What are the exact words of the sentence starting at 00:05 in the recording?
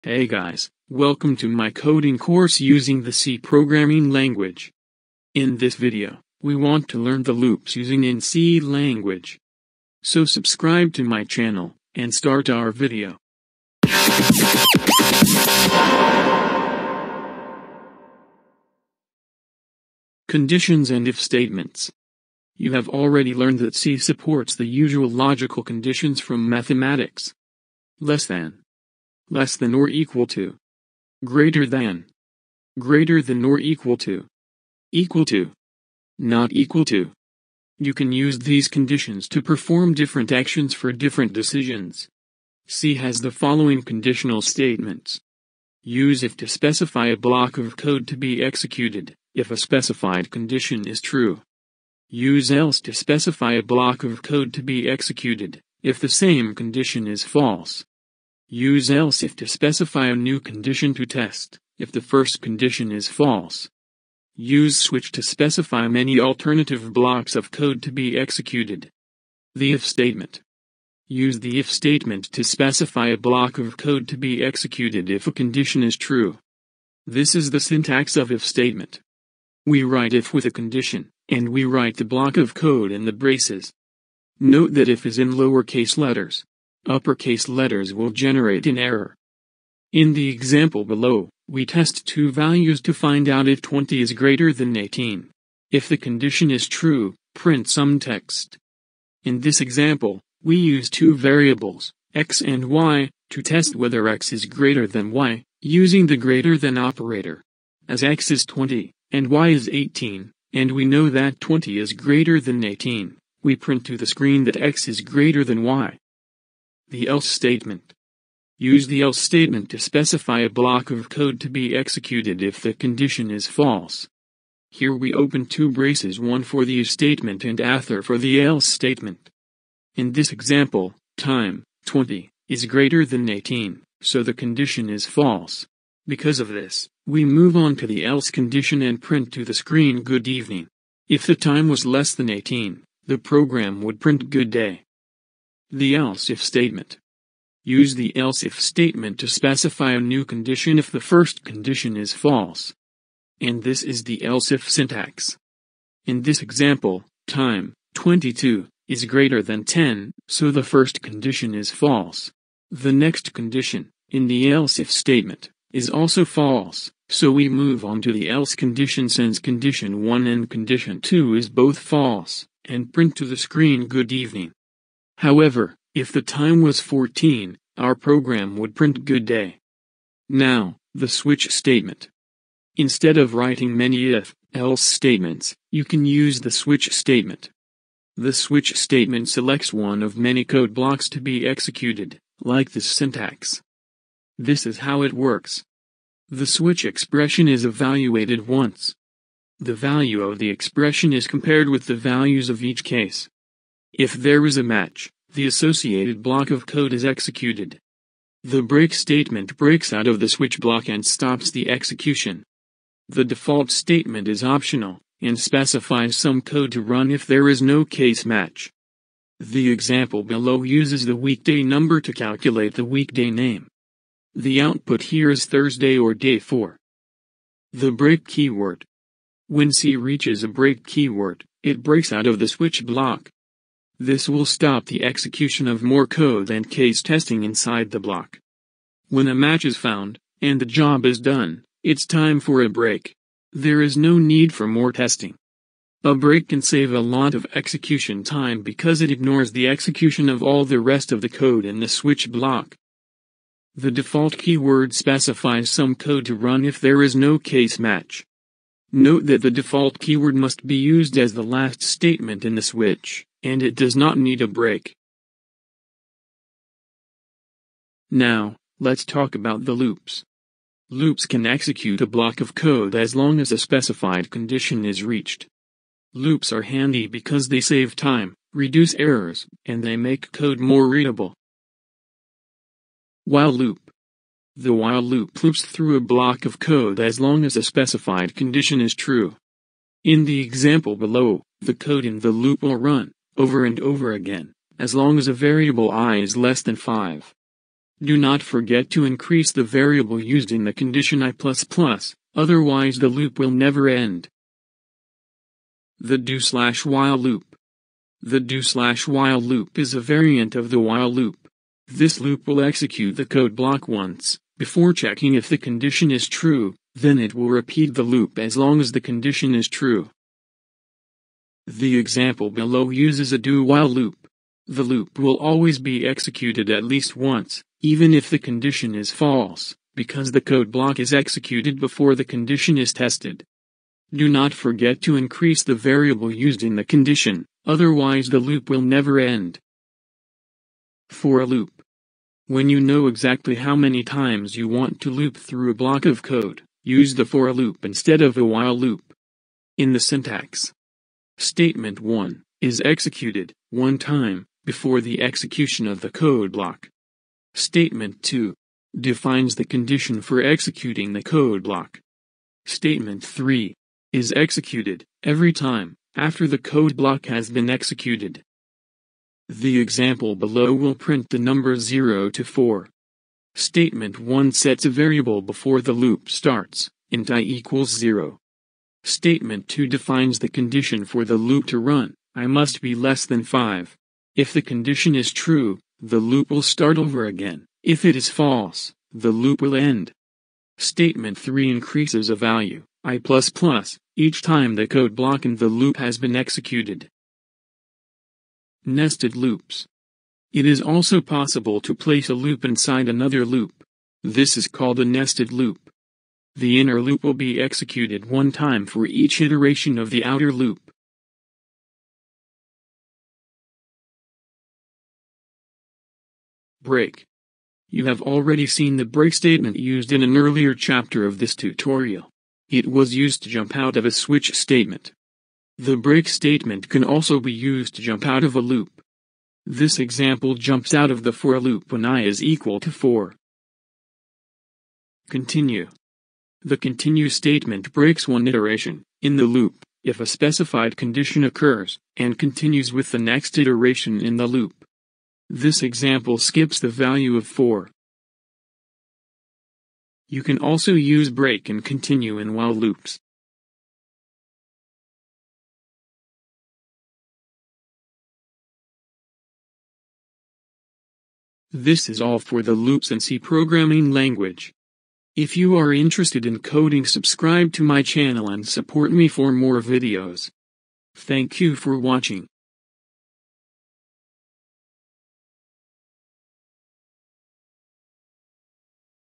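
In this video, we want to learn the loops using in C language.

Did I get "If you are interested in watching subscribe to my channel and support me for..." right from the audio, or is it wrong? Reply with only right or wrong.
wrong.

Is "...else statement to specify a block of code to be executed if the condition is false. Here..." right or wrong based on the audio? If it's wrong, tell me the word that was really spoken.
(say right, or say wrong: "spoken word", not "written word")
right.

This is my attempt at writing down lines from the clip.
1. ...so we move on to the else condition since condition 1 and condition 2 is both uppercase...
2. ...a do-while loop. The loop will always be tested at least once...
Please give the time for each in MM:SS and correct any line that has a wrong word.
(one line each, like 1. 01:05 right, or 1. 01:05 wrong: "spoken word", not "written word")
1. 02:47 wrong: "false", not "uppercase"
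2. 05:23 wrong: "executed", not "tested".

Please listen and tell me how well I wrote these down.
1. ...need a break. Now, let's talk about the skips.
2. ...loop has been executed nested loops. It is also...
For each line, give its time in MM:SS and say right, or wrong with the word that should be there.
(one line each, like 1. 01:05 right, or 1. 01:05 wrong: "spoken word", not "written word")
1. 04:24 wrong: "loops", not "skips"
2. 06:35 right.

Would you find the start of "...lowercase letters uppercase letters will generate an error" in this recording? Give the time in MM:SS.
01:25.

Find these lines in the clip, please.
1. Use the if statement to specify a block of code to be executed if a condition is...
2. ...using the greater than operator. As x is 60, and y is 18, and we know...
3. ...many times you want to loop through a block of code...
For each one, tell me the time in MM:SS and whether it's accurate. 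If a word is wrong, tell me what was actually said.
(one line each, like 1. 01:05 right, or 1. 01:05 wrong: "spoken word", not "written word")
1. 01:11 right
2. 01:45 wrong: "20", not "60"
3. 05:43 right.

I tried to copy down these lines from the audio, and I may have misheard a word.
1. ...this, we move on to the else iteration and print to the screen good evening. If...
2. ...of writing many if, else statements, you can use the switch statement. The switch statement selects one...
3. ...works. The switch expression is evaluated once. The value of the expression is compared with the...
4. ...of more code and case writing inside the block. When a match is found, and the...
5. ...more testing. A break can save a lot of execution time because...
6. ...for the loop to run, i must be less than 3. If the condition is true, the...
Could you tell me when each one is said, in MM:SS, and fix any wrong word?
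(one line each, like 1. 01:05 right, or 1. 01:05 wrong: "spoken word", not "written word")
1. 02:16 wrong: "condition", not "iteration"
2. 03:03 right
3. 03:15 right
4. 03:55 wrong: "testing", not "writing"
5. 04:04 right
6. 06:21 wrong: "5", not "3".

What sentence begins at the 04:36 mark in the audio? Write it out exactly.
Loops are handy because they save time, reduce errors, and they make code more readable.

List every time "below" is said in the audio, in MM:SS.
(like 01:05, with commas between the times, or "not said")
01:30, 03:40, 04:50, 05:22, 06:10.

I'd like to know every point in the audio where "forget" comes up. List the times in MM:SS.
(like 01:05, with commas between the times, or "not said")
04:58, 05:34.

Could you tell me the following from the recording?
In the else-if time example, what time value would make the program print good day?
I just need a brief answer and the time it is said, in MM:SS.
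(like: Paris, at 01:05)
14, at 02:55.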